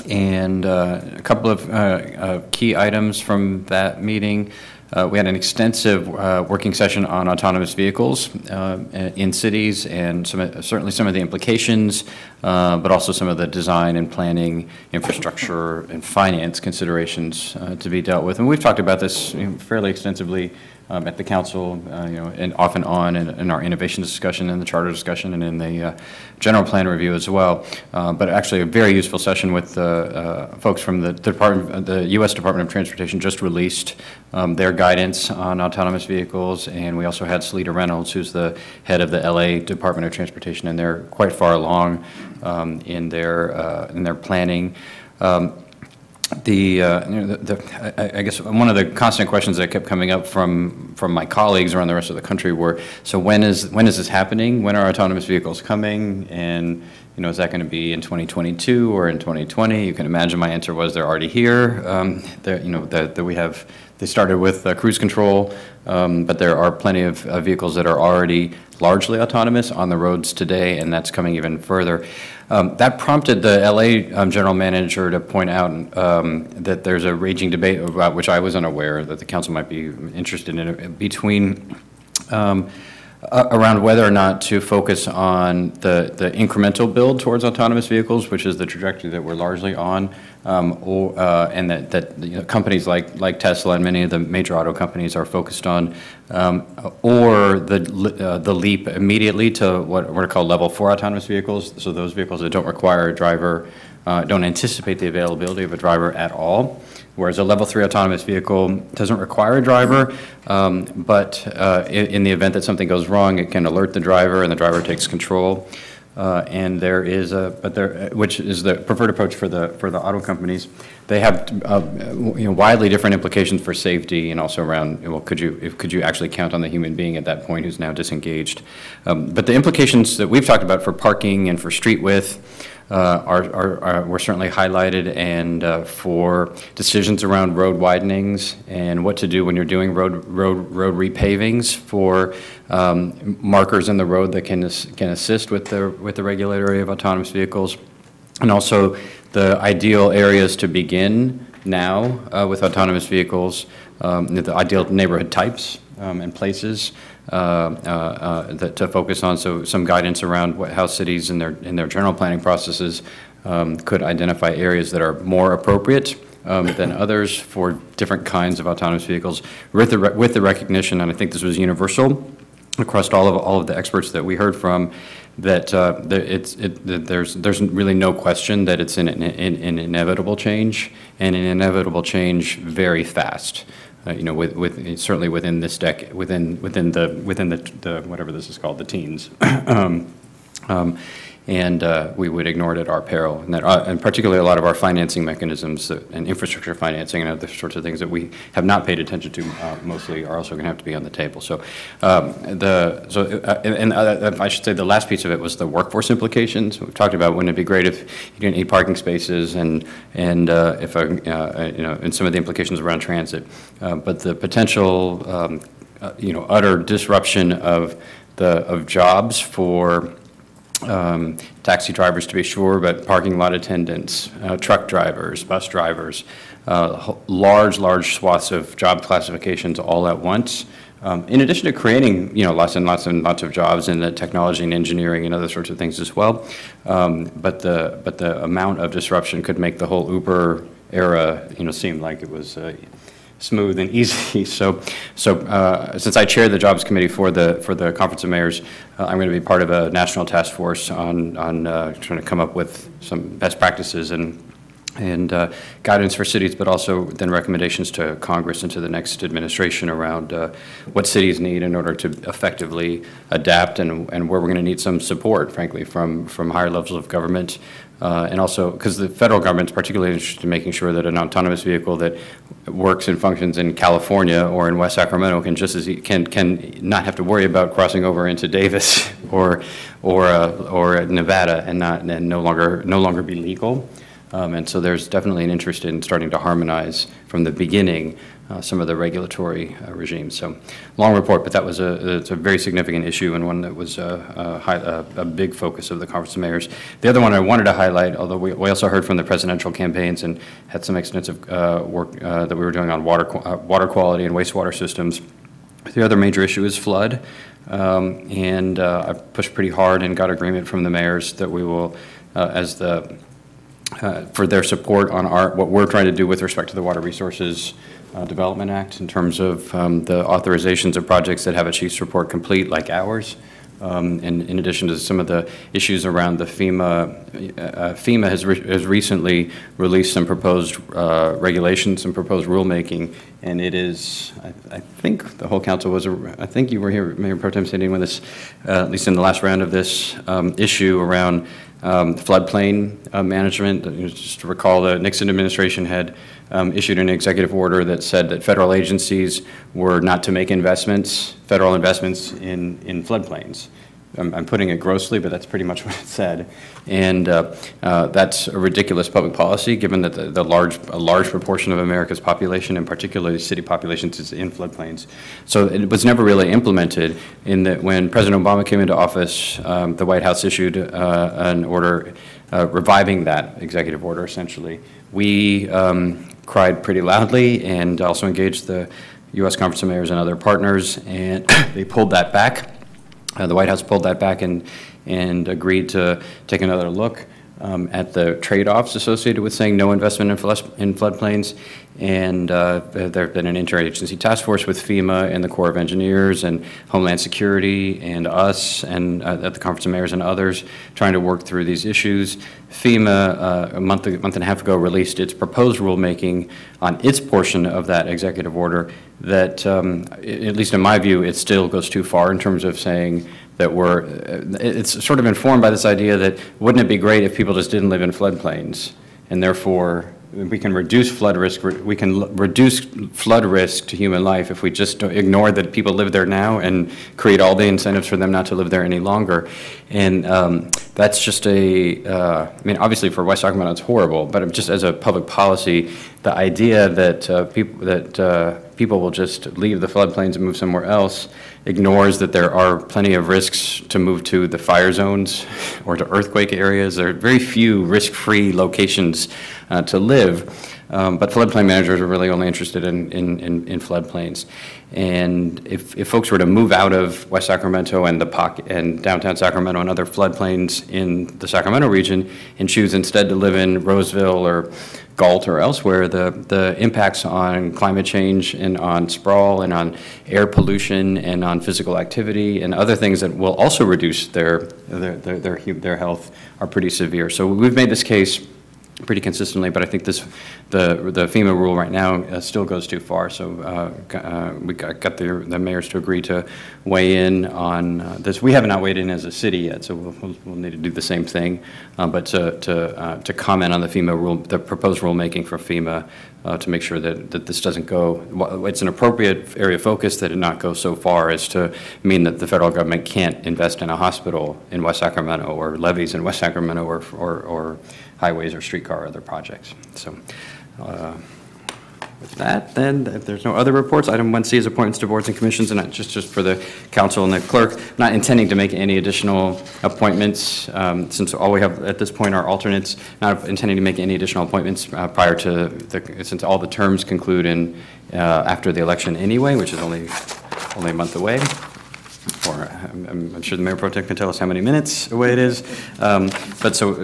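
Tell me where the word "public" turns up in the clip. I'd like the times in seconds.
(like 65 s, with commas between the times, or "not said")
359 s, 434 s.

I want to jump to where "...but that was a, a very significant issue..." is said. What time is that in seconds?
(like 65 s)
291 s.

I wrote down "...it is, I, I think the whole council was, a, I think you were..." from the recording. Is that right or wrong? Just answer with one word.
right.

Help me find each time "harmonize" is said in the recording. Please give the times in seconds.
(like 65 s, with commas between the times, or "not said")
286 s.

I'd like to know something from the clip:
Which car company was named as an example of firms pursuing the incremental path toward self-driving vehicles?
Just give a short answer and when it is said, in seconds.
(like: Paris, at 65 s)
Tesla, at 93 s.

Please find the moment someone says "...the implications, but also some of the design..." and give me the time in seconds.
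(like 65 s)
11 s.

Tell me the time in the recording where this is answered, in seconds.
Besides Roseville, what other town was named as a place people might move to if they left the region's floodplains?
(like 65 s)
465 s.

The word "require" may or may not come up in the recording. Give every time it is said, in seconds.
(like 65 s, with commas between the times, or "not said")
102 s, 109 s.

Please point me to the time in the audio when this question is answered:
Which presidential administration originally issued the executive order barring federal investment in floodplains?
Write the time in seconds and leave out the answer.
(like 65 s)
344 s.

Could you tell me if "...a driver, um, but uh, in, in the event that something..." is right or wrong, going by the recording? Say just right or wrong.
right.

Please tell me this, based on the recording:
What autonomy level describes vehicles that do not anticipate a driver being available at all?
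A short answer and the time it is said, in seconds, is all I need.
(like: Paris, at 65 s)
level four, at 100 s.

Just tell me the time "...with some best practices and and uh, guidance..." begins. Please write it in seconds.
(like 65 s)
252 s.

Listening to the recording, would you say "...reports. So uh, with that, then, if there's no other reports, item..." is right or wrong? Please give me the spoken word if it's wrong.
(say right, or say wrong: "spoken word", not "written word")
wrong: "projects", not "reports".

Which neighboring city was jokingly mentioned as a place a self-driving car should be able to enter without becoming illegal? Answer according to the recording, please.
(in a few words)
Davis.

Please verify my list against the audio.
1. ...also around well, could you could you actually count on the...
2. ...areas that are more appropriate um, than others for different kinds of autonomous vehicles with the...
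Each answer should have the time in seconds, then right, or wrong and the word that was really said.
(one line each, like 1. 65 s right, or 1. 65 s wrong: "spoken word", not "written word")
1. 124 s right
2. 164 s right.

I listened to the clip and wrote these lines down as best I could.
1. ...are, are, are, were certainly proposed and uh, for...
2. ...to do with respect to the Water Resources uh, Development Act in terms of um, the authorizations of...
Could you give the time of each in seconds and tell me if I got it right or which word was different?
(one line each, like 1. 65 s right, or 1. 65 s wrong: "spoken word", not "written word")
1. 133 s wrong: "highlighted", not "proposed"
2. 316 s right.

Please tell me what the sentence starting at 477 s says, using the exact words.
So we've made this case pretty consistently, but I think this, the, the FEMA rule right now uh, still goes too far.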